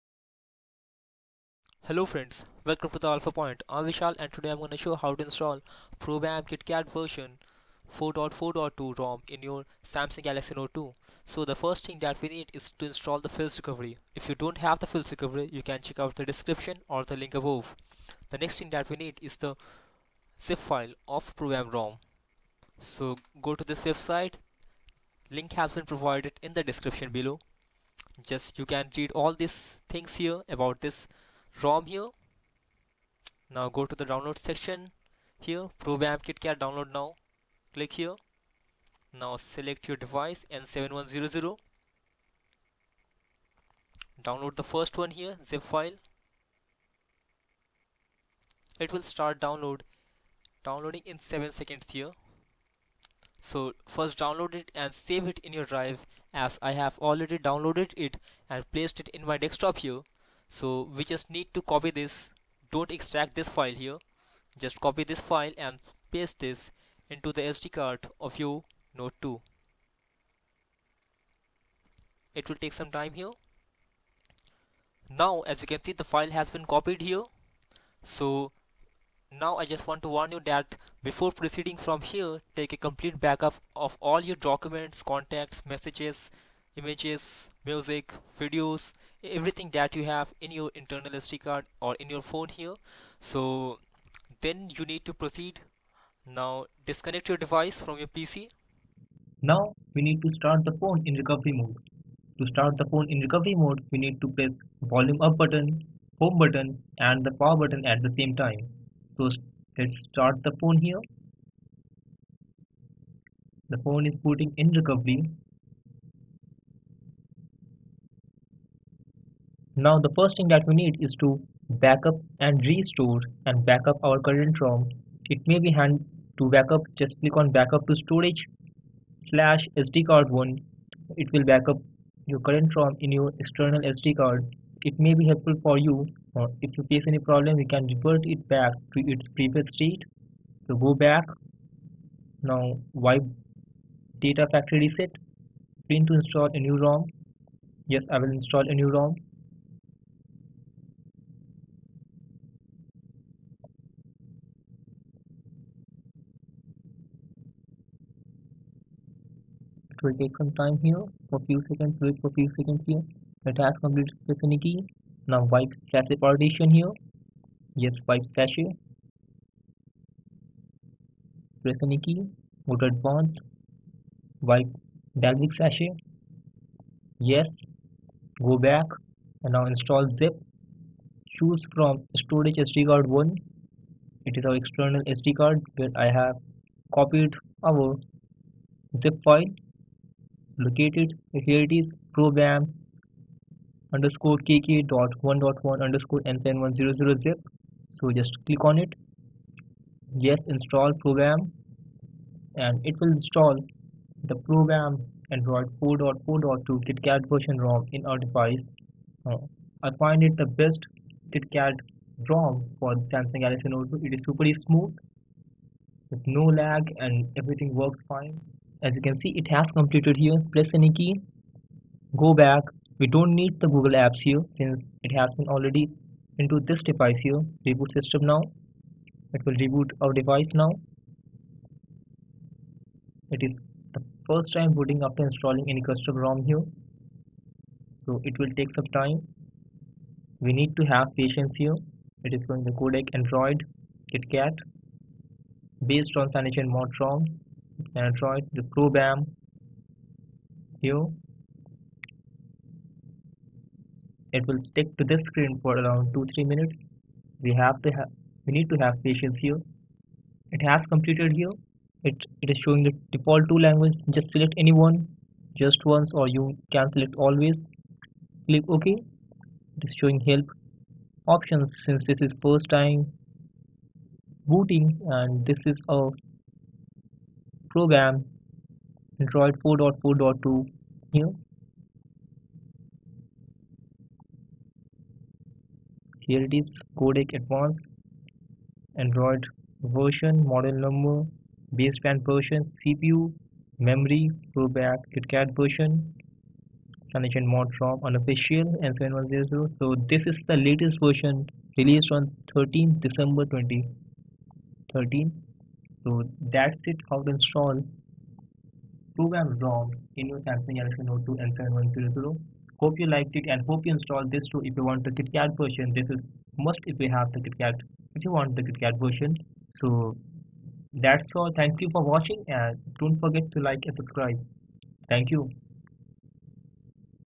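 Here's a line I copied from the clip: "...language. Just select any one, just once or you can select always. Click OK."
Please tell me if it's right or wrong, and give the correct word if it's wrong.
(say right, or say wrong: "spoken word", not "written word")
right.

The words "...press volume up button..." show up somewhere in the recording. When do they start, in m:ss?
1:44.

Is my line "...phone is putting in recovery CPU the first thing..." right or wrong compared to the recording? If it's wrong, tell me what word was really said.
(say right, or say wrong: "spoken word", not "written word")
wrong: "Now", not "CPU".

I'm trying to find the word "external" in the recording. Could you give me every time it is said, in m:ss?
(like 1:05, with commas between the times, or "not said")
2:13, 3:04.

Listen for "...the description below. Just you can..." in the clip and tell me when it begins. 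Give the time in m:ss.
0:26.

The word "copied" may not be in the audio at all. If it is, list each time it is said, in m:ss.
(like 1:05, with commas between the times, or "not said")
1:16, 3:07.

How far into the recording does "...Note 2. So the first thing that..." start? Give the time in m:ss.
0:10.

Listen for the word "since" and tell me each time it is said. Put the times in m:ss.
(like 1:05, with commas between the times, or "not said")
3:44, 4:31.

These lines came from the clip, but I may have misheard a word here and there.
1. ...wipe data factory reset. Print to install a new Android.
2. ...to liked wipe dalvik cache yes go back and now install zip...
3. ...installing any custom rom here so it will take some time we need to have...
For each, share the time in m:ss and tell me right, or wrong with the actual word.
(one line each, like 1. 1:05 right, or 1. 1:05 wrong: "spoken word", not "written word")
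1. 2:22 wrong: "ROM", not "Android"
2. 2:52 wrong: "advanced", not "liked"
3. 3:55 right.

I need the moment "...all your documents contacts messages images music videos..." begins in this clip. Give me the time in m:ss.
1:24.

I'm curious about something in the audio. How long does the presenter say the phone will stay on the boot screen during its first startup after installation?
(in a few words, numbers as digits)
2-3 minutes.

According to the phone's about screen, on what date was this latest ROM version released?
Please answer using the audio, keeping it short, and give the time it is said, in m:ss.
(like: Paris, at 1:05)
13 December 2013, at 5:02.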